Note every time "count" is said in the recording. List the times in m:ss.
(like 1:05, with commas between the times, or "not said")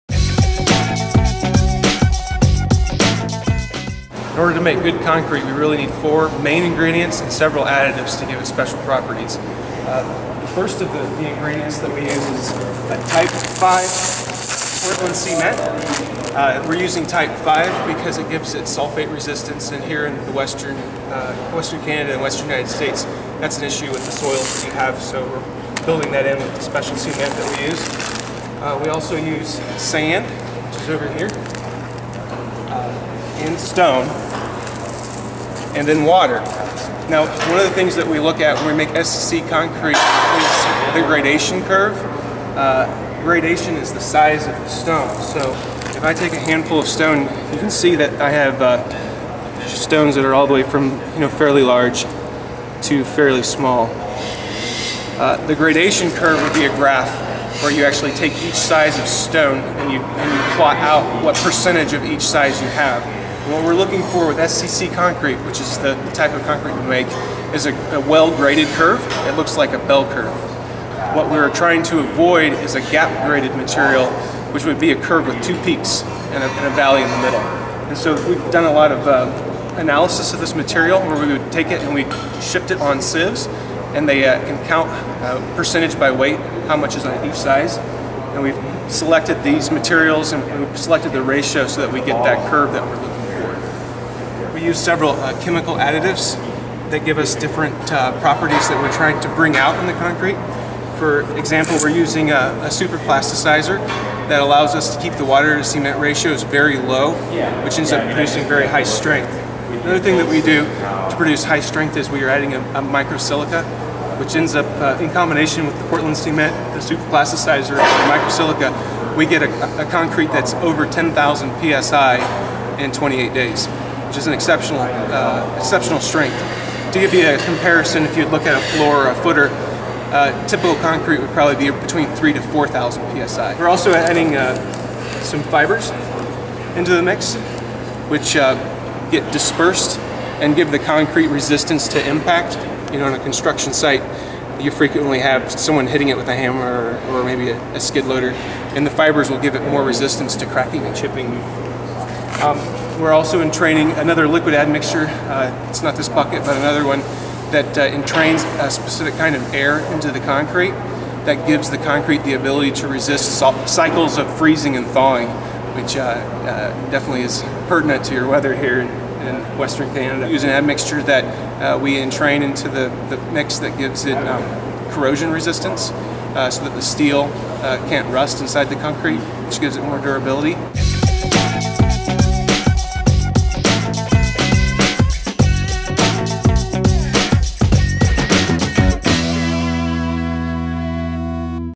1:24.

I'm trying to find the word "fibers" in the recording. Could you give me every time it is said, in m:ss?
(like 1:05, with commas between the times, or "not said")
2:15, 2:28.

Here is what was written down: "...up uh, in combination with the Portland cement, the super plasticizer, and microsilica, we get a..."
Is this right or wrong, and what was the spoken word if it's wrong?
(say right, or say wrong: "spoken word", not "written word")
right.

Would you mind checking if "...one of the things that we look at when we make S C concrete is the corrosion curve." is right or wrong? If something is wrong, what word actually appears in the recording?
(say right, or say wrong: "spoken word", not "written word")
wrong: "gradation", not "corrosion".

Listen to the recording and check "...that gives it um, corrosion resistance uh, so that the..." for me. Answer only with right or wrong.
right.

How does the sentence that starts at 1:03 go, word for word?
And what we're looking for with SCC concrete, which is the, the type of concrete we make, is a, a well-graded curve.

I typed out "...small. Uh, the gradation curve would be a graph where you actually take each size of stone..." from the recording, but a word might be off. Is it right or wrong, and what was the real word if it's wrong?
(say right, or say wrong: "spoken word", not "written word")
right.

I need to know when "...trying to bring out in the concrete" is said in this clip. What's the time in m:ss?
1:38.